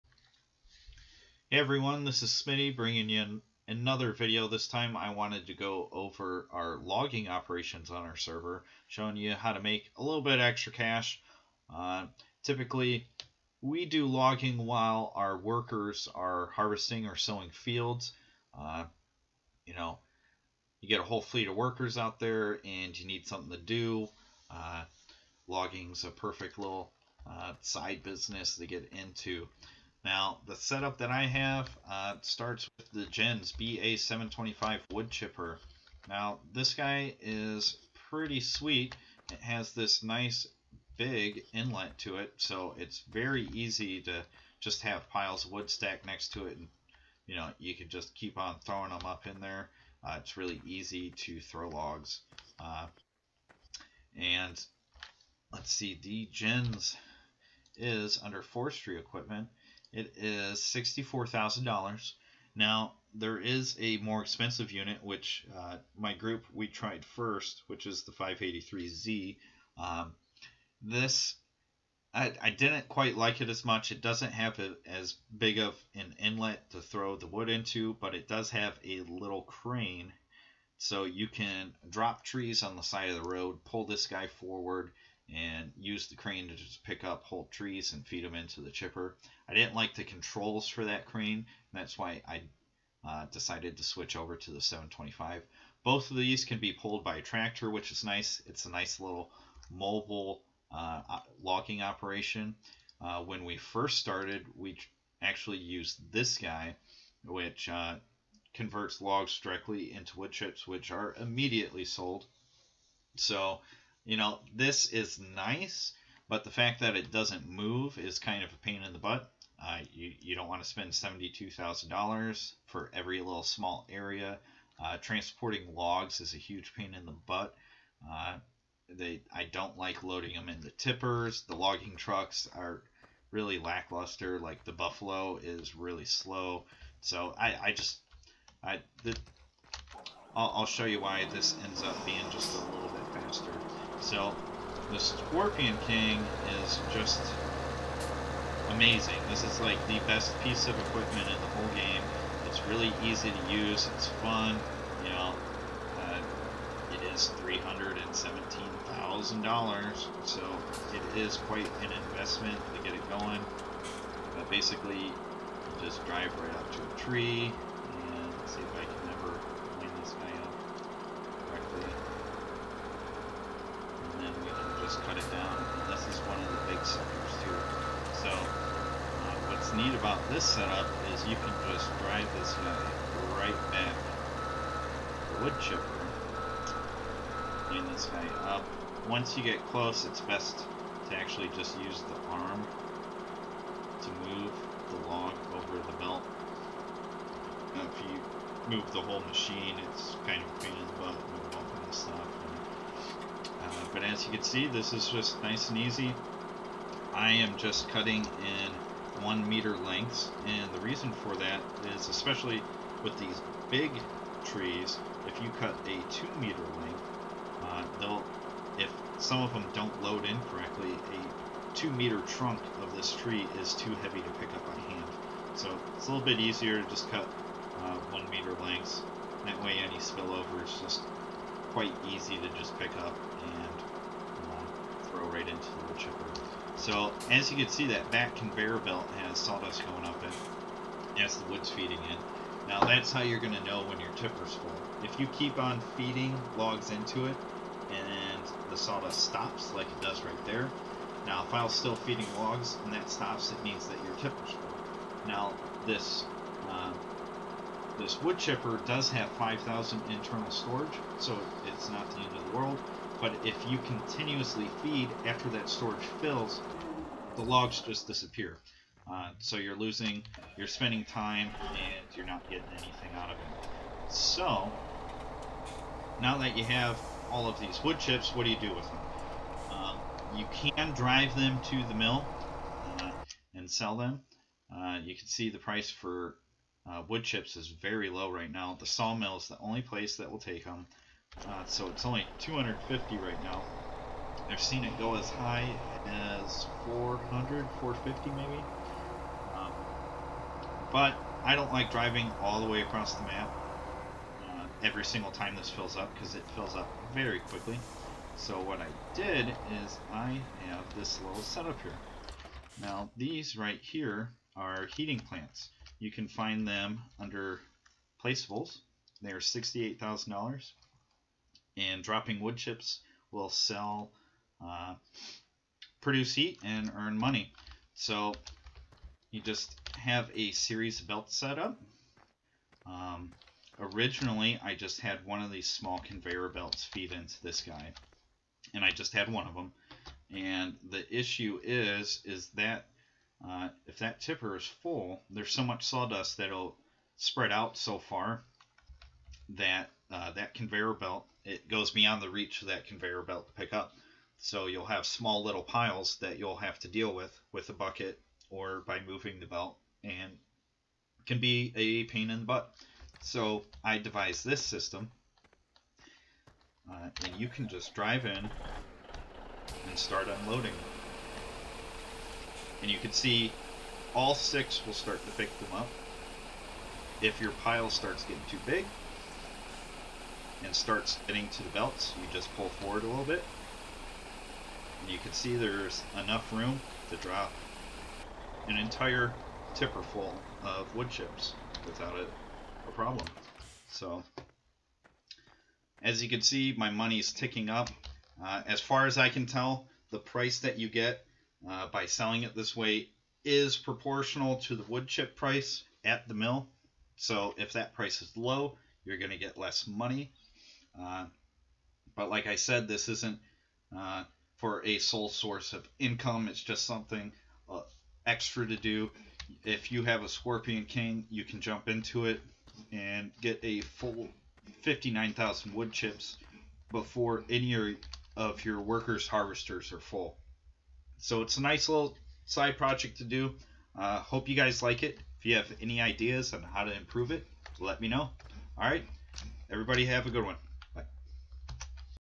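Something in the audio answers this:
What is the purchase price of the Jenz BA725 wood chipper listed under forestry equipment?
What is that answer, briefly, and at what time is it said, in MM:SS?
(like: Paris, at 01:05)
$64,000, at 01:00.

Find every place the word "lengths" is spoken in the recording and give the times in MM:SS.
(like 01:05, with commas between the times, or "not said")
03:29, 03:36, 03:48.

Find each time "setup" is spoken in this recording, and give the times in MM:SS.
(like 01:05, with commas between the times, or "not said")
00:30, 03:00, 05:11.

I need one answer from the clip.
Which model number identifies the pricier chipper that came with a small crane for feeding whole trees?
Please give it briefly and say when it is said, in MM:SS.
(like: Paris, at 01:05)
583Z, at 01:08.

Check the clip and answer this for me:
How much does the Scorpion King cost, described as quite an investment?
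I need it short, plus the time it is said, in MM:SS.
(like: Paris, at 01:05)
$317,000, at 02:37.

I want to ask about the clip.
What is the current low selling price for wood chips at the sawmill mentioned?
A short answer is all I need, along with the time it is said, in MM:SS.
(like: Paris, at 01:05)
250, at 04:52.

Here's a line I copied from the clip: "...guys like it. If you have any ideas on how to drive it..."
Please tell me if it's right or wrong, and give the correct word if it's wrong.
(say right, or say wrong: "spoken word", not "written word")
wrong: "improve", not "drive".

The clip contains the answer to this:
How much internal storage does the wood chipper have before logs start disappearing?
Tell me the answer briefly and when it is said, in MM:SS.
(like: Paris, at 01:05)
5,000, at 04:19.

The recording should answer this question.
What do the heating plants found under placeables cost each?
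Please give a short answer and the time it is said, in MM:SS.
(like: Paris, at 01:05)
$68,000, at 05:19.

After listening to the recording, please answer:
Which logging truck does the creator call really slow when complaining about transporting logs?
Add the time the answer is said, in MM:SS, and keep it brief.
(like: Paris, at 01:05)
Buffalo, at 02:14.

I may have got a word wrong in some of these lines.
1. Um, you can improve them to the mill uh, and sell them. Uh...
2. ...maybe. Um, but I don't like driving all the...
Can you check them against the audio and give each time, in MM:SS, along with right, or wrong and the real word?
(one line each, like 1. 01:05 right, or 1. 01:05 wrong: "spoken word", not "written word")
1. 04:39 wrong: "drive", not "improve"
2. 04:58 right.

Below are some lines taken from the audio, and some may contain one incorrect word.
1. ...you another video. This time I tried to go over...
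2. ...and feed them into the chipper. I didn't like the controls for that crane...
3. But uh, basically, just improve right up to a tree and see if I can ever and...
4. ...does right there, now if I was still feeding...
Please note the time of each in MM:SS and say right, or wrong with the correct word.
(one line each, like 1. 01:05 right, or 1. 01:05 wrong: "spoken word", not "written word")
1. 00:03 wrong: "wanted", not "tried"
2. 01:27 right
3. 02:44 wrong: "drive", not "improve"
4. 04:10 right.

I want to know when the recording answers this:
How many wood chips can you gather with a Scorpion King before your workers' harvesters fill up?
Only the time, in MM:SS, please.
07:04.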